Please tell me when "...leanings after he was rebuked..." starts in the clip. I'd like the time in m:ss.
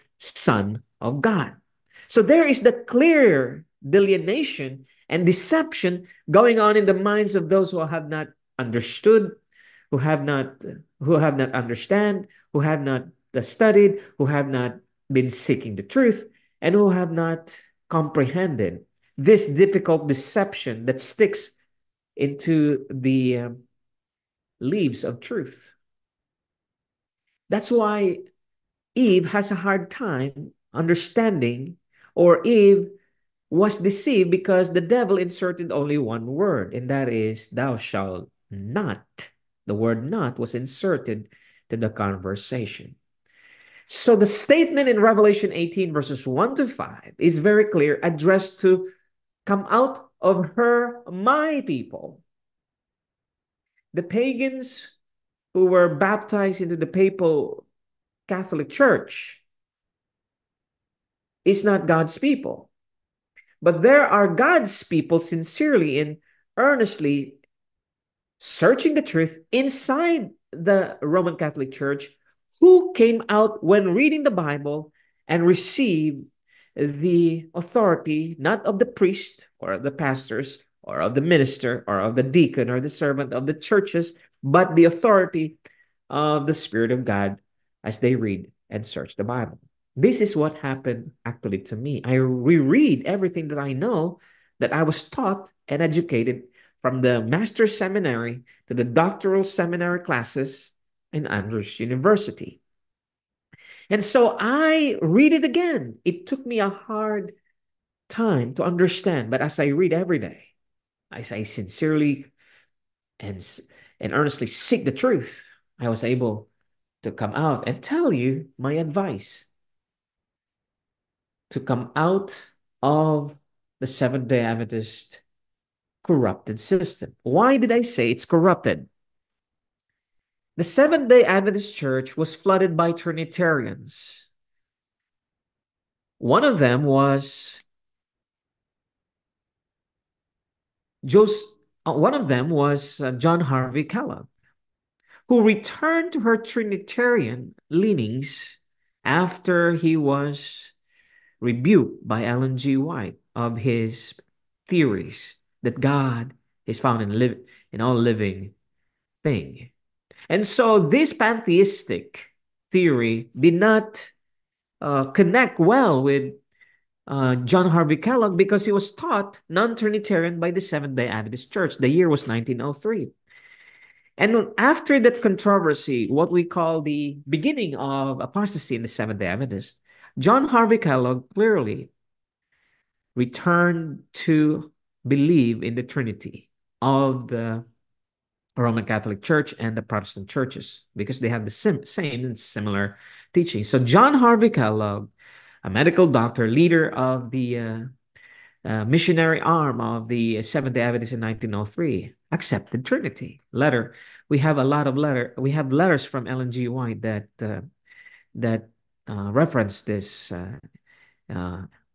2:27.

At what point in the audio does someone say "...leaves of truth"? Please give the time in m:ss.
0:24.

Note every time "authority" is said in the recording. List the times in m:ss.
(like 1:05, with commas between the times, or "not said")
1:17, 1:24.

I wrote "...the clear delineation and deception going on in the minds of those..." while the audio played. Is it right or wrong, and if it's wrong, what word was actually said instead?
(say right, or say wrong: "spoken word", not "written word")
right.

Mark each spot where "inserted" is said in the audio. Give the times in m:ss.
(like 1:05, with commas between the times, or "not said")
0:35, 0:40.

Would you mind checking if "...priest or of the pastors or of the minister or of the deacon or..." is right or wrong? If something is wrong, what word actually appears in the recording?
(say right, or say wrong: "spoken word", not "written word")
right.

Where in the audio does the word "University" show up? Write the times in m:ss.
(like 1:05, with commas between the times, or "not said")
1:41.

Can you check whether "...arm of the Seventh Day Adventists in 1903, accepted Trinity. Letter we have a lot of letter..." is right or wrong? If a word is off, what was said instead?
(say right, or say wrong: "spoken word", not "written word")
right.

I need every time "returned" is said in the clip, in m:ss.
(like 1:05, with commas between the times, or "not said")
2:25, 3:03.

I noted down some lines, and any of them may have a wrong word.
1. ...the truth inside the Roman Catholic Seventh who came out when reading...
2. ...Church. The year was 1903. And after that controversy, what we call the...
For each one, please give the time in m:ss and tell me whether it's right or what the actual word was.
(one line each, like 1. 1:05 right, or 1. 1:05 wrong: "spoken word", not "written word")
1. 1:08 wrong: "Church", not "Seventh"
2. 2:51 right.